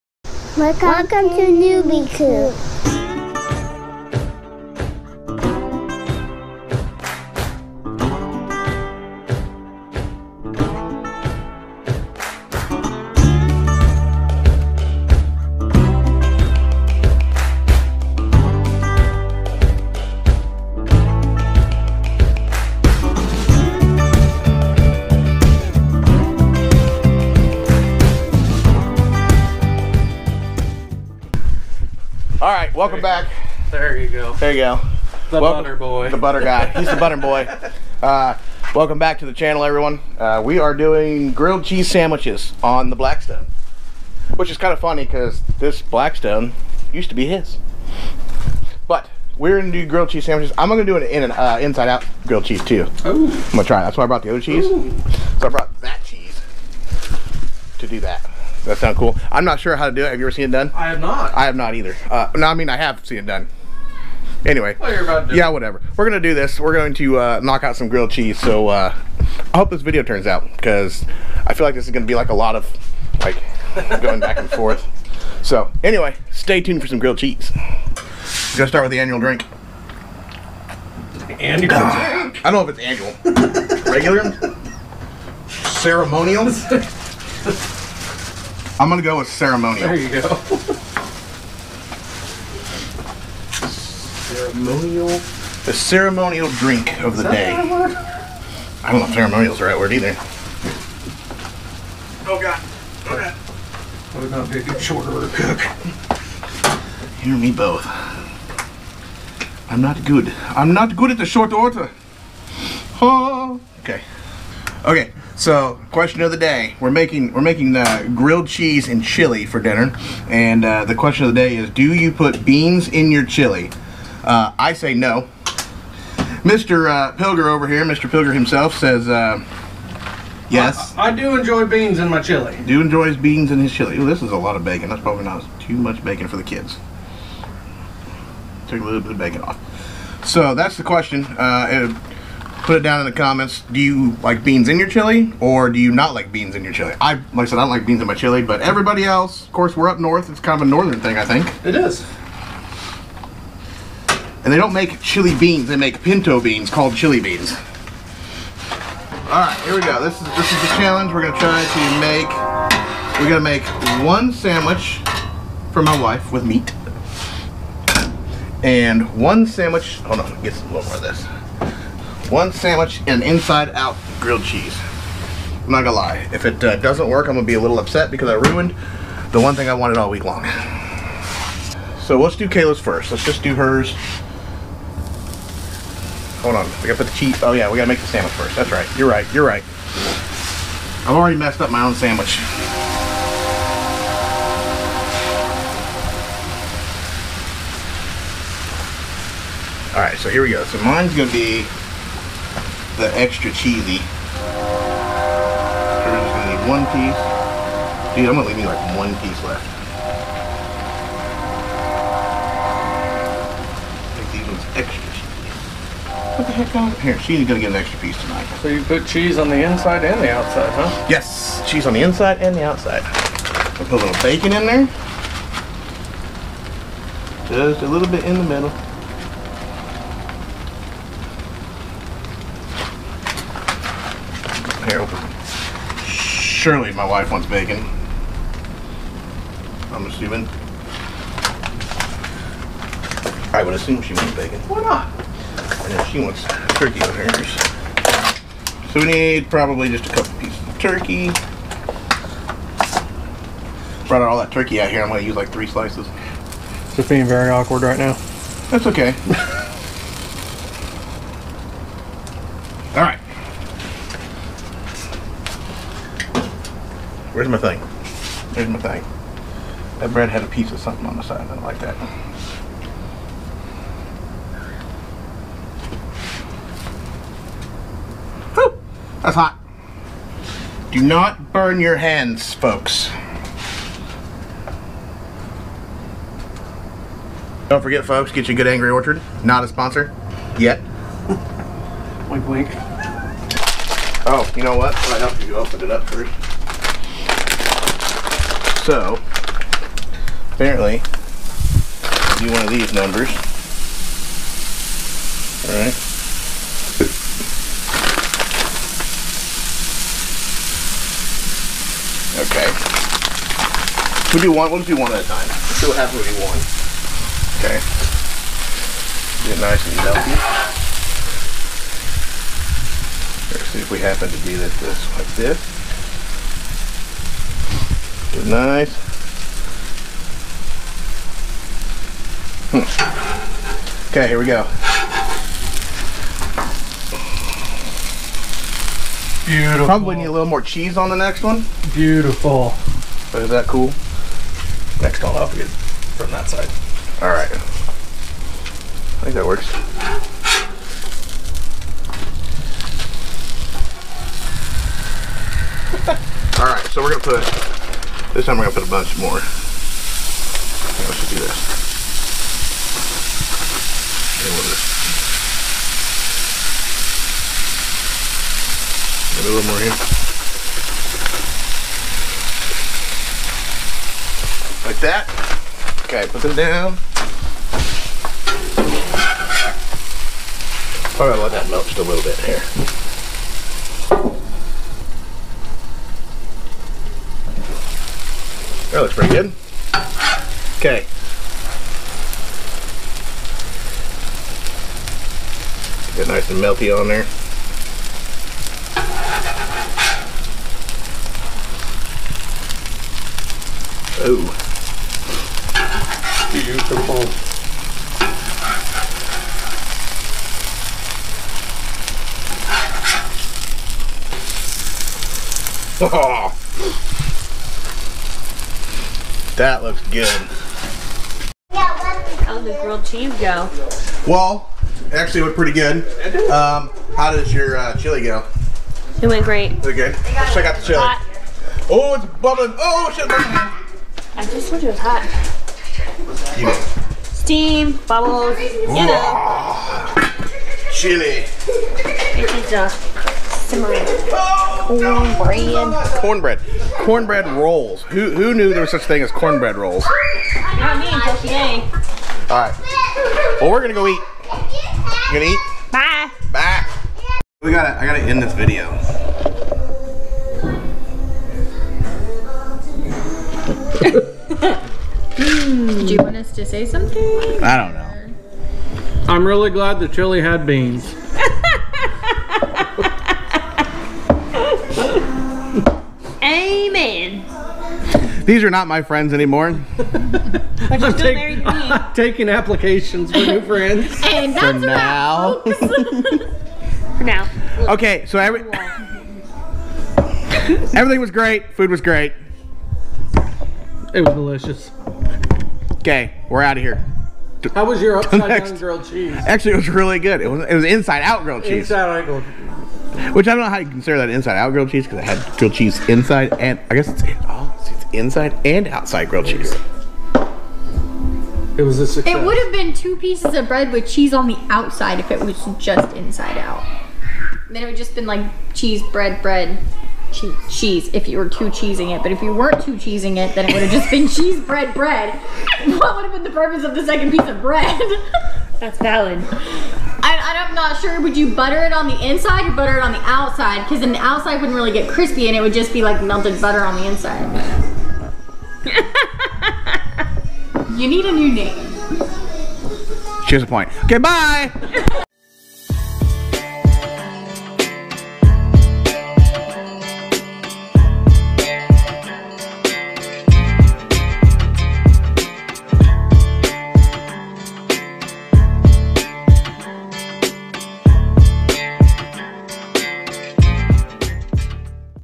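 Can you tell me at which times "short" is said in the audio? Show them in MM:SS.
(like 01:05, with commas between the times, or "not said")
01:44, 01:51.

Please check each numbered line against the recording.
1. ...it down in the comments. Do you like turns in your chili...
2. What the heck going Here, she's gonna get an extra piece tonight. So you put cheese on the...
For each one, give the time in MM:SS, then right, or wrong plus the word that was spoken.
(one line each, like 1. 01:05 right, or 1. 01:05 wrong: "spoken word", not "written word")
1. 02:22 wrong: "beans", not "turns"
2. 03:36 right.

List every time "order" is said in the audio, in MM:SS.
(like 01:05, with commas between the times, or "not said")
01:45, 01:51.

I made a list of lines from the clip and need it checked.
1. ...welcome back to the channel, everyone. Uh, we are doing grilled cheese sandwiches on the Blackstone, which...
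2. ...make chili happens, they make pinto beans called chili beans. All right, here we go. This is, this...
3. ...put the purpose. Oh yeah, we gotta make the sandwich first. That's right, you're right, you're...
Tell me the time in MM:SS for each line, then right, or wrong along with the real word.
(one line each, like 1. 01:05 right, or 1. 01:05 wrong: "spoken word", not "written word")
1. 00:38 right
2. 02:34 wrong: "beans", not "happens"
3. 03:06 wrong: "cheese", not "purpose".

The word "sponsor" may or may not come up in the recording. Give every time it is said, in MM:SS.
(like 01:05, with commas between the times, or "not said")
04:49.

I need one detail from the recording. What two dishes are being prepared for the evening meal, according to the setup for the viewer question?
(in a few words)
Grilled cheese and chili.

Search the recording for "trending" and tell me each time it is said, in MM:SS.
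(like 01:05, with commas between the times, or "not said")
not said.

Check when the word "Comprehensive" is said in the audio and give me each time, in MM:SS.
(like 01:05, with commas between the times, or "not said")
not said.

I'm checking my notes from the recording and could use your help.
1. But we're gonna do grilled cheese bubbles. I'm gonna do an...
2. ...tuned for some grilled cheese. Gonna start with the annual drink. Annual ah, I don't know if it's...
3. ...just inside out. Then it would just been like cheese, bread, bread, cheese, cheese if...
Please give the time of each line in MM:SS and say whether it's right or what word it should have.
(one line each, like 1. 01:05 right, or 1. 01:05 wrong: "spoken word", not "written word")
1. 00:48 wrong: "sandwiches", not "bubbles"
2. 01:16 right
3. 08:35 right.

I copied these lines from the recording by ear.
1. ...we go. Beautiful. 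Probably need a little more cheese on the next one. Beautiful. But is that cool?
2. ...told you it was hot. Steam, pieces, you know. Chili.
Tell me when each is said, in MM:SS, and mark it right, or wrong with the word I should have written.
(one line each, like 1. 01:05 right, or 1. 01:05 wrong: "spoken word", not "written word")
1. 05:34 right
2. 07:14 wrong: "bubbles", not "pieces".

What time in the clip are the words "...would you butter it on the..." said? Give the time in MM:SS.
08:51.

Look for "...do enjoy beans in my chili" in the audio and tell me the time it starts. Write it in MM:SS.
02:11.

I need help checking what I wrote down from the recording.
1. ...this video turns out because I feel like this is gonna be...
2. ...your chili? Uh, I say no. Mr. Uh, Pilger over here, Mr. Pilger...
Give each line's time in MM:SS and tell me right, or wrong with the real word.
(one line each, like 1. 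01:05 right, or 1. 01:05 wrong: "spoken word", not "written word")
1. 01:09 right
2. 02:03 right.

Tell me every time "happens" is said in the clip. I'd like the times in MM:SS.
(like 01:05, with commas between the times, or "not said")
05:15, 05:23.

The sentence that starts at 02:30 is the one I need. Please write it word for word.
It's kind of a northern thing, I think.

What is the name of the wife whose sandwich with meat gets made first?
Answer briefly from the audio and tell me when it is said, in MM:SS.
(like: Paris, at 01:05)
Kayla, at 03:02.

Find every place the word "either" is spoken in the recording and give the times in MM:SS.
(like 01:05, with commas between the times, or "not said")
01:01, 01:39.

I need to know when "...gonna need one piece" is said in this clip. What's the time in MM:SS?
03:26.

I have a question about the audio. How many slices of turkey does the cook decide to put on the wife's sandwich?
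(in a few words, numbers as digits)
3.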